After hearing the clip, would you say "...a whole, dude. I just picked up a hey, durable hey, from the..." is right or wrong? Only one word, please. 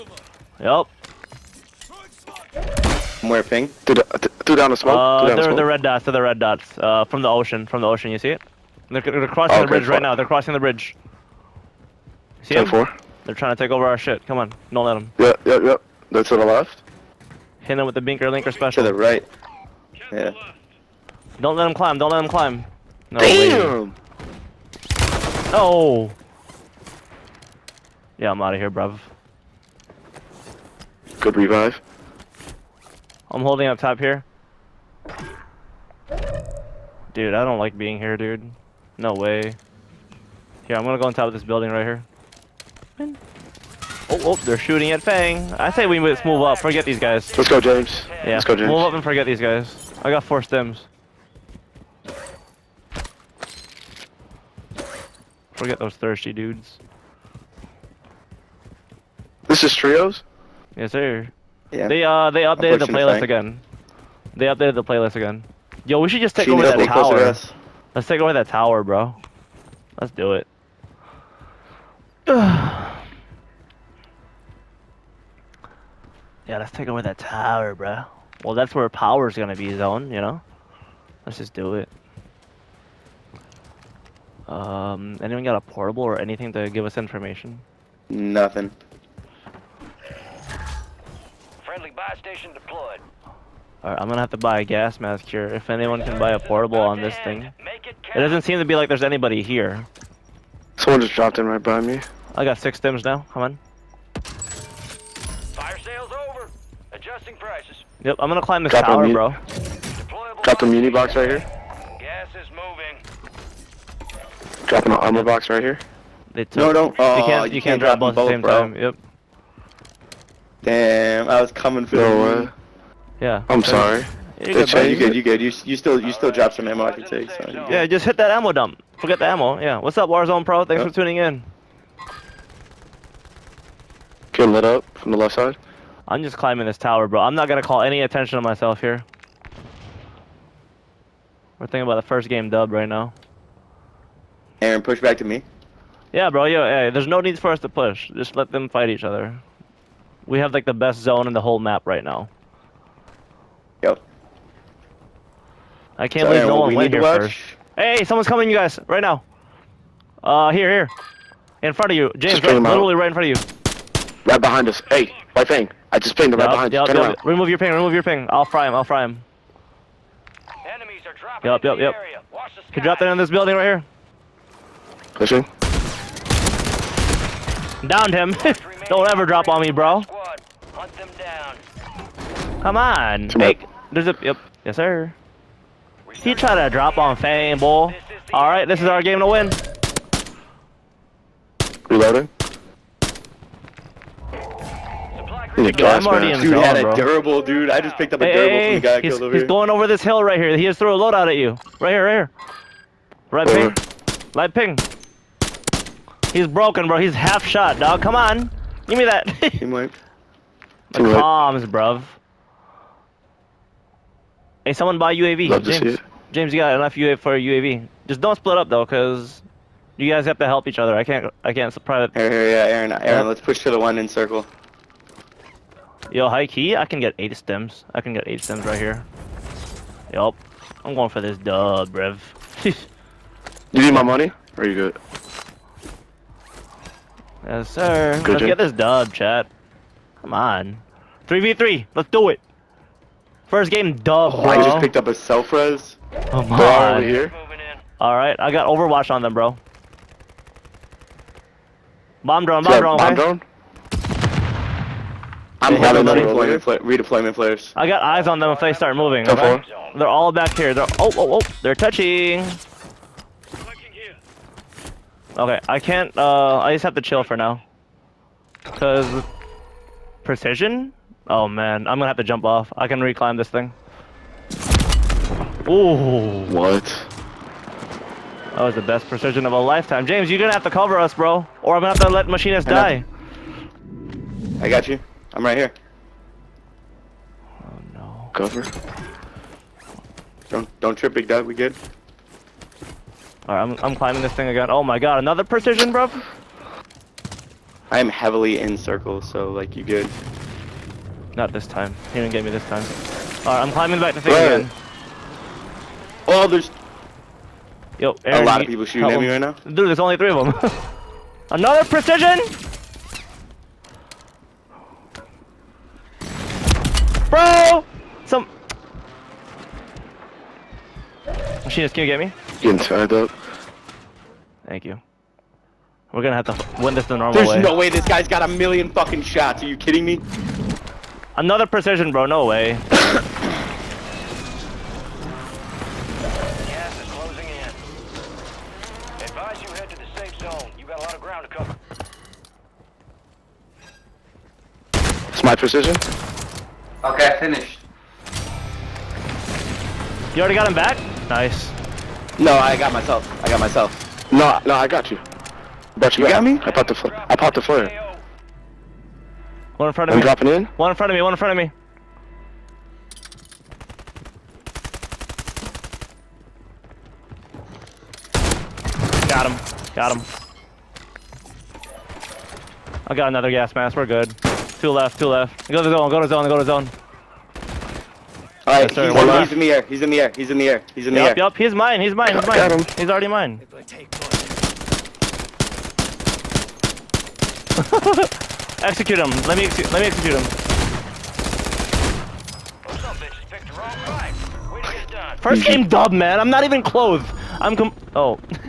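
wrong.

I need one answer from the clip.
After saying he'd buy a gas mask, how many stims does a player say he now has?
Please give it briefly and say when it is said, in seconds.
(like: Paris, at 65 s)
6, at 102 s.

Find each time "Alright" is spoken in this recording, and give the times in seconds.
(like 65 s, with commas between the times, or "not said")
93 s, 247 s, 303 s, 378 s.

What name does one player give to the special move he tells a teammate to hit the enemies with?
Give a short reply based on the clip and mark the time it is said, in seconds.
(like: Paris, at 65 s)
binker linker special, at 17 s.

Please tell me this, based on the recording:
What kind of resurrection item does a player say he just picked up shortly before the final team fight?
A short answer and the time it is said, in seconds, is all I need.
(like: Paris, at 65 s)
self res, at 245 s.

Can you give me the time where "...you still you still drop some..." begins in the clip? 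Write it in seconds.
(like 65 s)
125 s.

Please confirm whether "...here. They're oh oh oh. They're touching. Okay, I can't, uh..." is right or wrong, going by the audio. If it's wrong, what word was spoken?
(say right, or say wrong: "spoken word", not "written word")
right.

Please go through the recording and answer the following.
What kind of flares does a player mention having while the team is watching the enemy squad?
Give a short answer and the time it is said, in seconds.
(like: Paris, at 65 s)
redeployment flares, at 256 s.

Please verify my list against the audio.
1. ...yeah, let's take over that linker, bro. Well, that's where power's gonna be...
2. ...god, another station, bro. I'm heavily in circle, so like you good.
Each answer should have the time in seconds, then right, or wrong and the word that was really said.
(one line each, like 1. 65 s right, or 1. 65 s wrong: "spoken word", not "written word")
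1. 72 s wrong: "tower", not "linker"
2. 294 s wrong: "precision", not "station".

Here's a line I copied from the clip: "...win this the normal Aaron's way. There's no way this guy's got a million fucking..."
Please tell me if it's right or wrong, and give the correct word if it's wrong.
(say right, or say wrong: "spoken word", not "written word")
wrong: "There", not "Aaron".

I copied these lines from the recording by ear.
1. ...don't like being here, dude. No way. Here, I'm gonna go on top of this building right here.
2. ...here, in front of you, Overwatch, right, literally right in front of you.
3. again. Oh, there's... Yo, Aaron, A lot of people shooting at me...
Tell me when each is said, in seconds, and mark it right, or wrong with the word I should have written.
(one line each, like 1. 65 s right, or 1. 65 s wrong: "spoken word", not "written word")
1. 37 s right
2. 160 s wrong: "James", not "Overwatch"
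3. 304 s right.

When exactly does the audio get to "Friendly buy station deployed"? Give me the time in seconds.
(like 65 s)
91 s.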